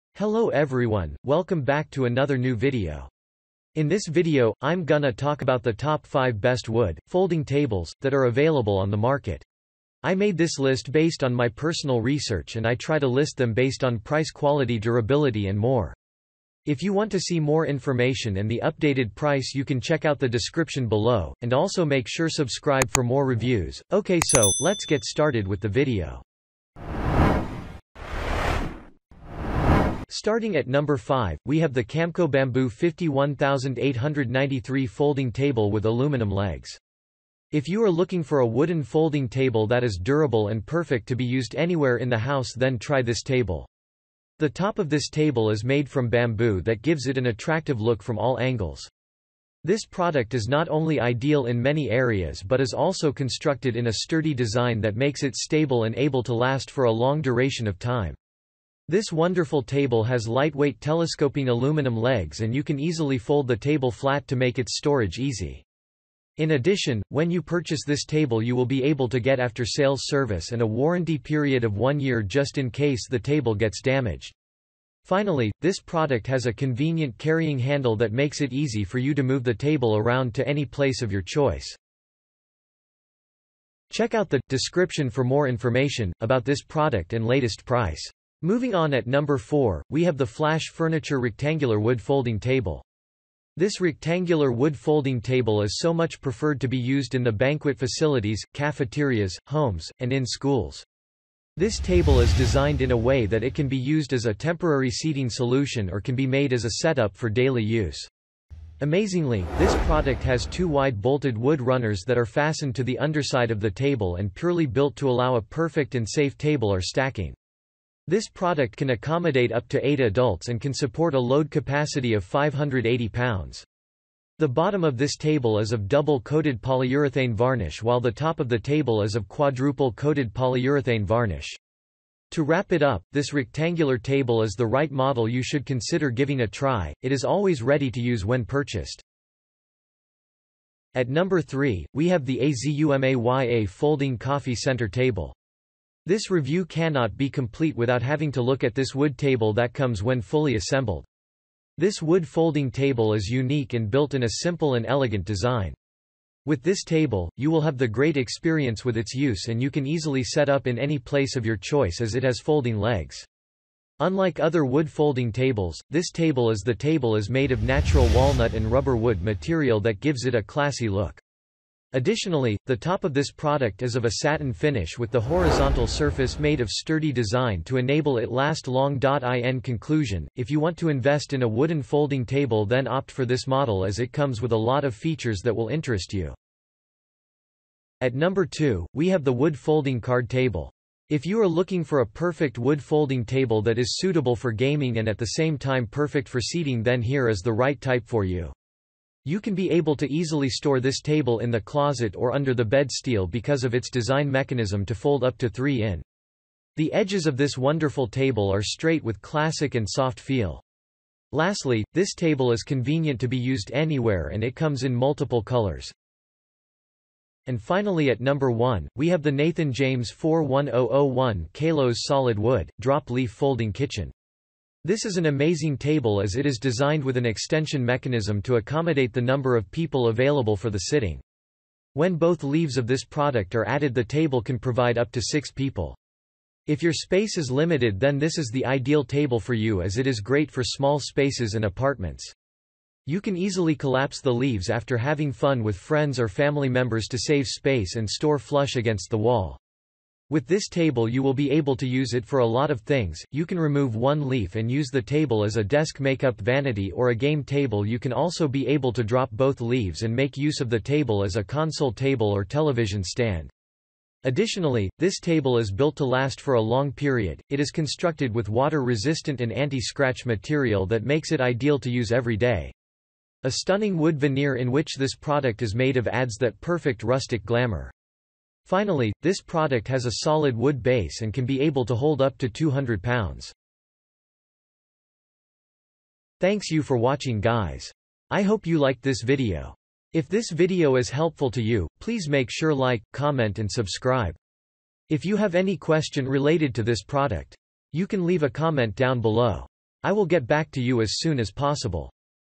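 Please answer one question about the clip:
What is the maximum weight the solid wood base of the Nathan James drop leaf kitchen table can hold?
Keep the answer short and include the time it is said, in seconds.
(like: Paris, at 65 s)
200 pounds, at 282 s.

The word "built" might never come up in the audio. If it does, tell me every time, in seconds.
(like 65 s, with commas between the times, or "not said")
114 s, 153 s, 265 s.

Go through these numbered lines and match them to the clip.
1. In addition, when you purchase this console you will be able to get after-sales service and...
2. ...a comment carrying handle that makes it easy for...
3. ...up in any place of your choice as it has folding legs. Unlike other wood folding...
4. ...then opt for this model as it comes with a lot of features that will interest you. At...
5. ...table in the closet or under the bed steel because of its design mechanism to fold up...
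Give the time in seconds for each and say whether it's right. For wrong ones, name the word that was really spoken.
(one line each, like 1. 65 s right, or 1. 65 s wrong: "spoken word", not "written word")
1. 66 s wrong: "table", not "console"
2. 76 s wrong: "convenient", not "comment"
3. 160 s right
4. 182 s right
5. 200 s right.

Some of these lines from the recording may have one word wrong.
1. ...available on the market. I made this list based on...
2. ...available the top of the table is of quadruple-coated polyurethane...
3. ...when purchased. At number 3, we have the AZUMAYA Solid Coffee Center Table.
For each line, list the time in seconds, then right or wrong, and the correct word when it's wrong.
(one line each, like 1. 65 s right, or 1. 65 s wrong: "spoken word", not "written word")
1. 8 s right
2. 127 s wrong: "while", not "available"
3. 138 s wrong: "Folding", not "Solid".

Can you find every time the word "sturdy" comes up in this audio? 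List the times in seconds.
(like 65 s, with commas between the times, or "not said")
53 s, 176 s.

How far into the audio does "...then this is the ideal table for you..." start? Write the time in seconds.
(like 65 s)
237 s.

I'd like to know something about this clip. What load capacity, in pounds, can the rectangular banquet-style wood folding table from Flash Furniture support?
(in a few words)
580 pounds.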